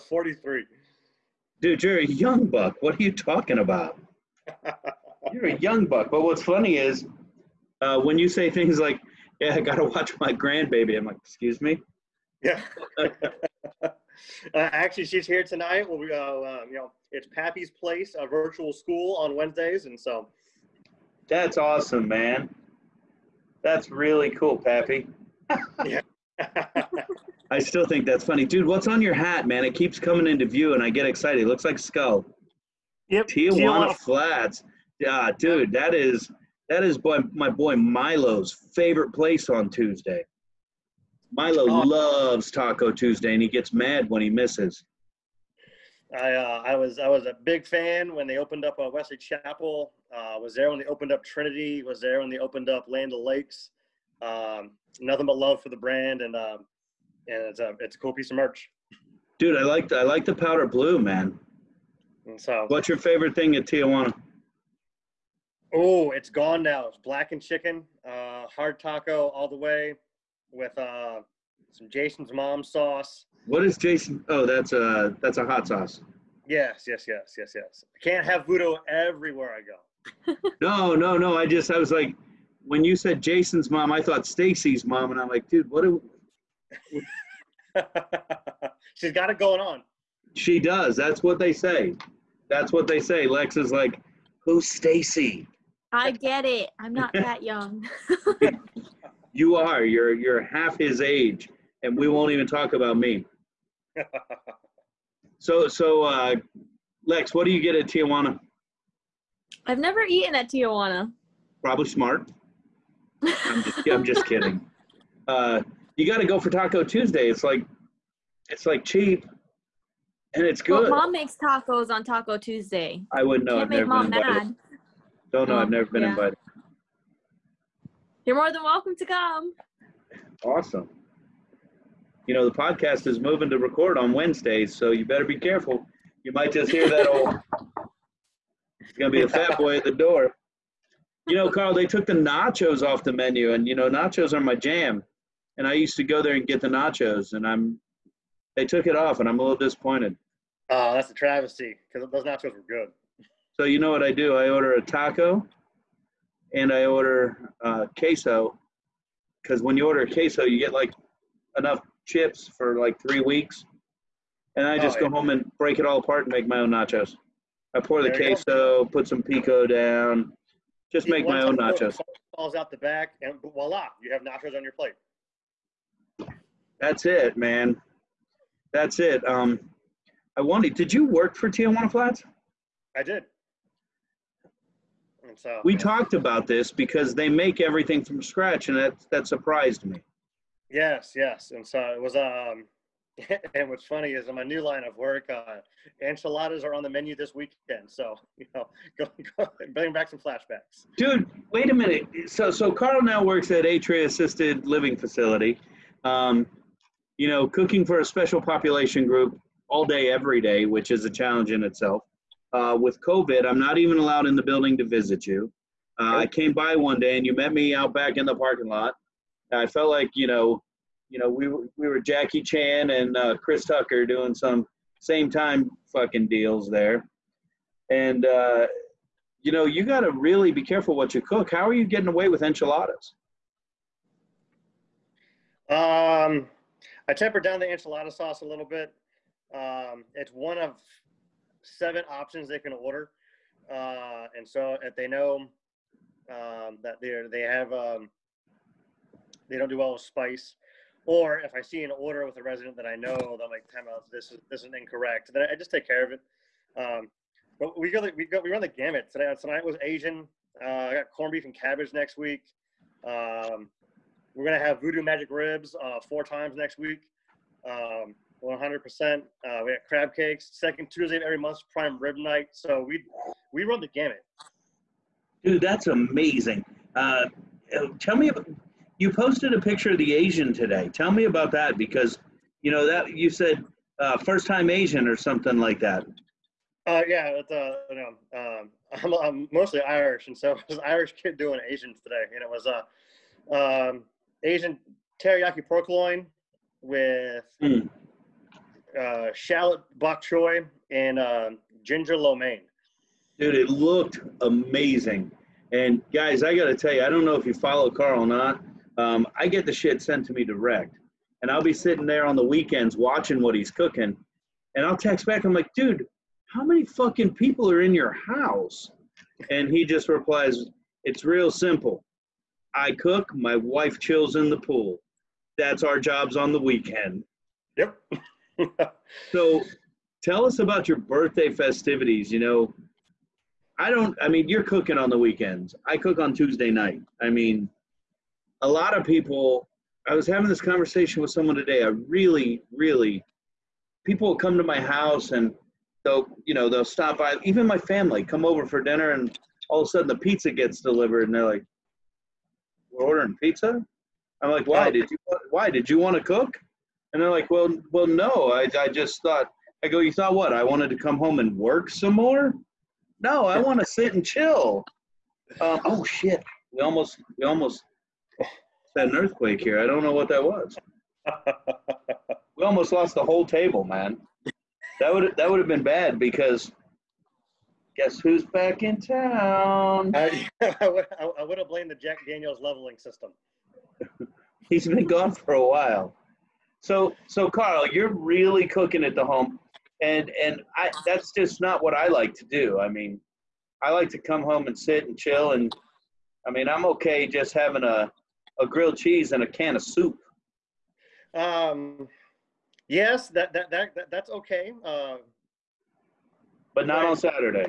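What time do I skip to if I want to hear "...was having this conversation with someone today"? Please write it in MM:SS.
05:40.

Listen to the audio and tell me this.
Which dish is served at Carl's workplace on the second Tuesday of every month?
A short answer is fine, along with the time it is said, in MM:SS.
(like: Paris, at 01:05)
Prime rib, at 04:31.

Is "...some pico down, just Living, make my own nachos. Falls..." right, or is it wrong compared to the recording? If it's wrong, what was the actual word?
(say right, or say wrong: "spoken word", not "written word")
wrong: "See", not "Living".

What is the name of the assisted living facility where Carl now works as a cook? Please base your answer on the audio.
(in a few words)
Atria.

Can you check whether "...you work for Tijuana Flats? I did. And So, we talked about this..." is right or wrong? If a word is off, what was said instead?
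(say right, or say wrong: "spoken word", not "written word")
right.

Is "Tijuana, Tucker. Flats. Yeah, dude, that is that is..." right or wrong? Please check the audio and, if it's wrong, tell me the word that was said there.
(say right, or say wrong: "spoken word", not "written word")
wrong: "Tijuana", not "Tucker".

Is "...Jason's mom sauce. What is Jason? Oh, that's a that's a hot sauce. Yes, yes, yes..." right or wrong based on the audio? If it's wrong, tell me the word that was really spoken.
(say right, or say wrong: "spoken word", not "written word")
right.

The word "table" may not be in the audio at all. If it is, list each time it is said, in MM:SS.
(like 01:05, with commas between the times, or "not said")
06:13.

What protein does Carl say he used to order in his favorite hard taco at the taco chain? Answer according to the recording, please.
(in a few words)
Blackened chicken.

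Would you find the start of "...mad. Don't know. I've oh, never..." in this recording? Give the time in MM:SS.
02:04.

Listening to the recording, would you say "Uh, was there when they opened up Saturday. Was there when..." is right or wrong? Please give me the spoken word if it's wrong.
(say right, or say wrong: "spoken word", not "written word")
wrong: "Trinity", not "Saturday".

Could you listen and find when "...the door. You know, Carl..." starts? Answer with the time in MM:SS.
02:19.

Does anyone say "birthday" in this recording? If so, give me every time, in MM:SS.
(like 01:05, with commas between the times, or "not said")
05:30.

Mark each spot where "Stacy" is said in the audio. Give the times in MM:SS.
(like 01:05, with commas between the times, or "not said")
01:24, 01:34.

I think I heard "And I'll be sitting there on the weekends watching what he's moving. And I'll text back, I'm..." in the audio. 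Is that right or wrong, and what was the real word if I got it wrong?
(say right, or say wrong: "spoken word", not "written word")
wrong: "cooking", not "moving".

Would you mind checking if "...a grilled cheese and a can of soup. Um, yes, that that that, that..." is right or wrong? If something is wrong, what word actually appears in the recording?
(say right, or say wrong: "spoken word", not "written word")
right.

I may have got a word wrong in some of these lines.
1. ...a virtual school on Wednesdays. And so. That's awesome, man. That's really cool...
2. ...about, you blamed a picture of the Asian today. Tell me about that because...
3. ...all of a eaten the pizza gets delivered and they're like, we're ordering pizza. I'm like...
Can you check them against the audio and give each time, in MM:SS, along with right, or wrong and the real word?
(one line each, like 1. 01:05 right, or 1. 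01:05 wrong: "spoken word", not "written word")
1. 00:18 right
2. 04:38 wrong: "posted", not "blamed"
3. 05:49 wrong: "sudden", not "eaten".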